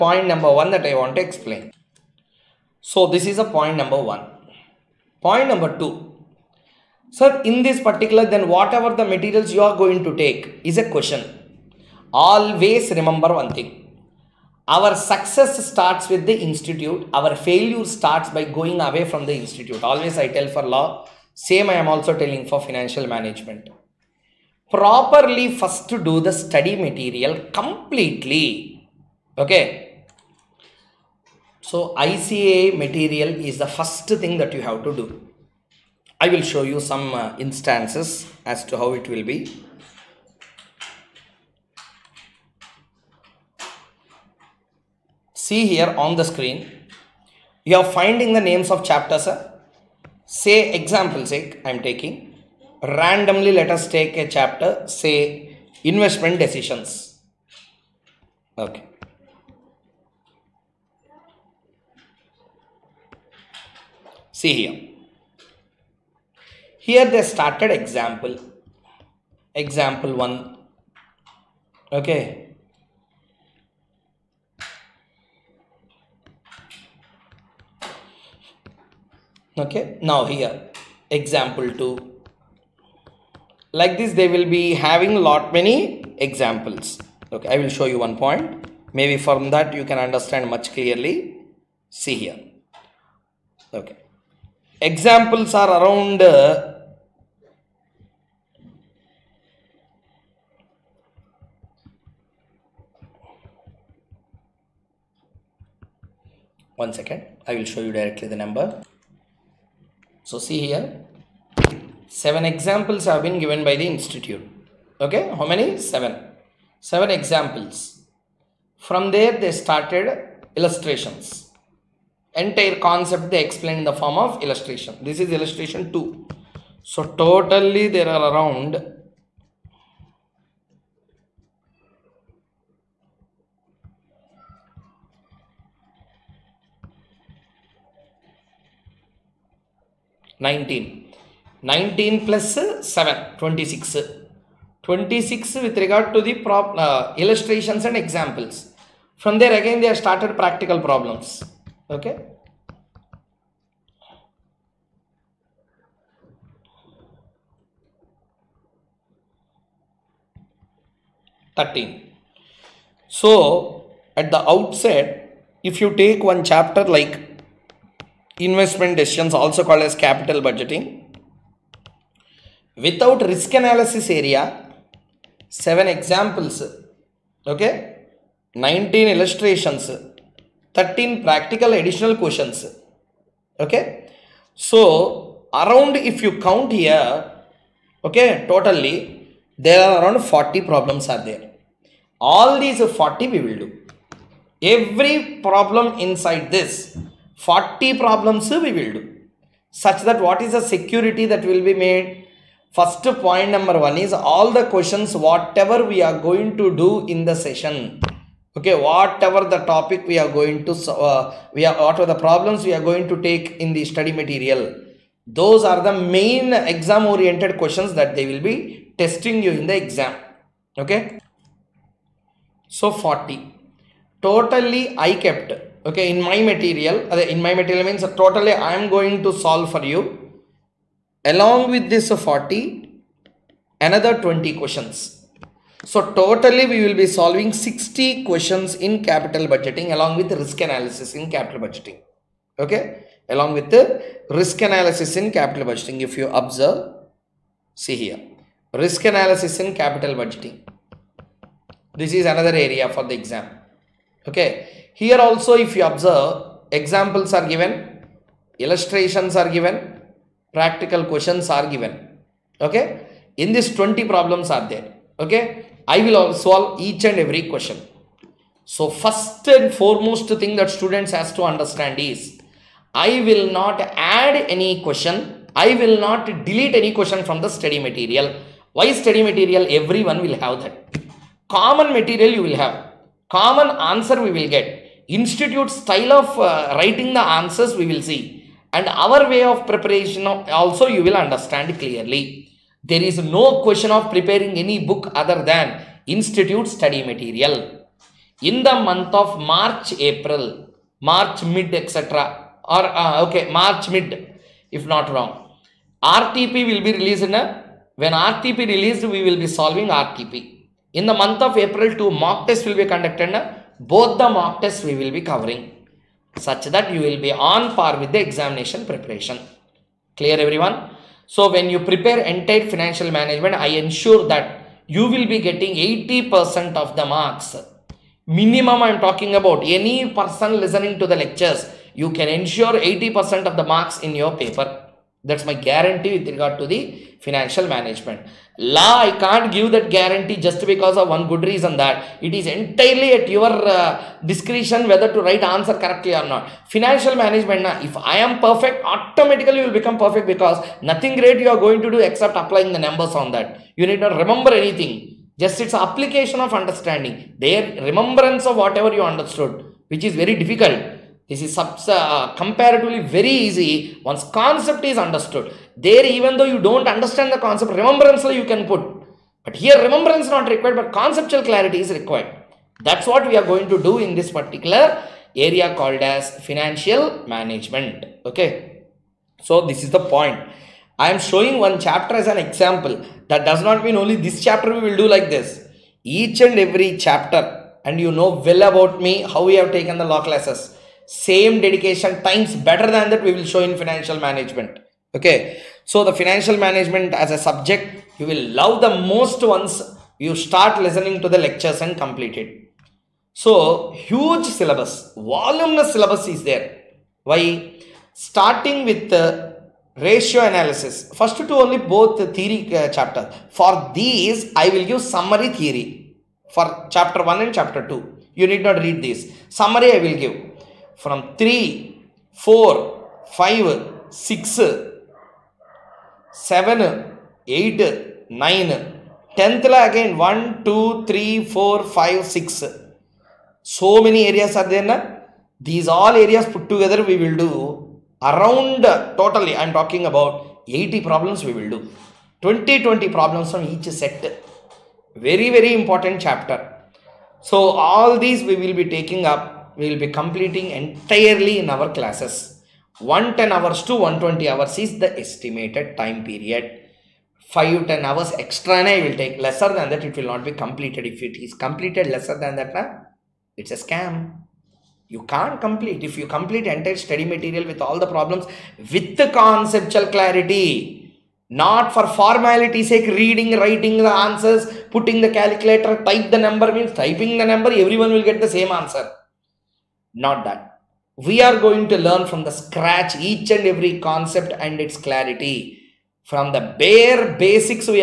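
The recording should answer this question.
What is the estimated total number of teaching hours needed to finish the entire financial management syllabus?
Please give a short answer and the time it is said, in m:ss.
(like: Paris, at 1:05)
110 to 120 hours, at 7:32.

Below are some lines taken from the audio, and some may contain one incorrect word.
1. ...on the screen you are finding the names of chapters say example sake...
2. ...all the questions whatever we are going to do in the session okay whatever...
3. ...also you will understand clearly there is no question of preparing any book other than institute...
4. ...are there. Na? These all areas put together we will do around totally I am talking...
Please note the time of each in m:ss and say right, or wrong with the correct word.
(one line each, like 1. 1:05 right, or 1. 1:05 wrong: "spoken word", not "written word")
1. 0:46 right
2. 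3:24 right
3. 4:50 right
4. 7:14 right.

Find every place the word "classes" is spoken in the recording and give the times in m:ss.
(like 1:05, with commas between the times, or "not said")
6:30, 7:31.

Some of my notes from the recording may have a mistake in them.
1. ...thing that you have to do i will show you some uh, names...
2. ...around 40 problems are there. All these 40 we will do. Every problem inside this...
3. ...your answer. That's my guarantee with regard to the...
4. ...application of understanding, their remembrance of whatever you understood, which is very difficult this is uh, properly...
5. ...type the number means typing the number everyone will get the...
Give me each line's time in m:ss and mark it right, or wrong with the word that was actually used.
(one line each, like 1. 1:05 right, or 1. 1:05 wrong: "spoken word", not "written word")
1. 0:34 wrong: "instances", not "names"
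2. 3:10 right
3. 5:34 wrong: "paper", not "answer"
4. 5:55 wrong: "comparatively", not "properly"
5. 7:56 right.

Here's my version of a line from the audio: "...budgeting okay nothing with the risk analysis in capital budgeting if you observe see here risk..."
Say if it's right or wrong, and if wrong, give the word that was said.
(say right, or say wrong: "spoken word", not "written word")
wrong: "along", not "nothing".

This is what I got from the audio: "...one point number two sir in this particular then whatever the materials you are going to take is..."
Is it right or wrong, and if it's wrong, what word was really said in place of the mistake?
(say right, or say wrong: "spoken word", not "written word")
right.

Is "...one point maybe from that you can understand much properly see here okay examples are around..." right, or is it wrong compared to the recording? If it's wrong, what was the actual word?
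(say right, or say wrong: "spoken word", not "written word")
wrong: "clearly", not "properly".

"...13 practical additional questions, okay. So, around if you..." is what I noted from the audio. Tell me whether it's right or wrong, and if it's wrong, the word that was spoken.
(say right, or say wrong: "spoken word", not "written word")
right.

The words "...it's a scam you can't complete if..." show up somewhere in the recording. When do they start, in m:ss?
7:43.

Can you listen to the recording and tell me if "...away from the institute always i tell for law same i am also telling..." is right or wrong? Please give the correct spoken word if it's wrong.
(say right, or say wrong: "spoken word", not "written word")
right.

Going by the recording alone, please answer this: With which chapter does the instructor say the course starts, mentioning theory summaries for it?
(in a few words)
ratio analysis.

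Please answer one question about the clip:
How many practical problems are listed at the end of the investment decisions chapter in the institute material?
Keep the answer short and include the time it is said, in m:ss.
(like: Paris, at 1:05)
13, at 2:41.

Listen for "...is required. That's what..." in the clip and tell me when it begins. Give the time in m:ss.
6:11.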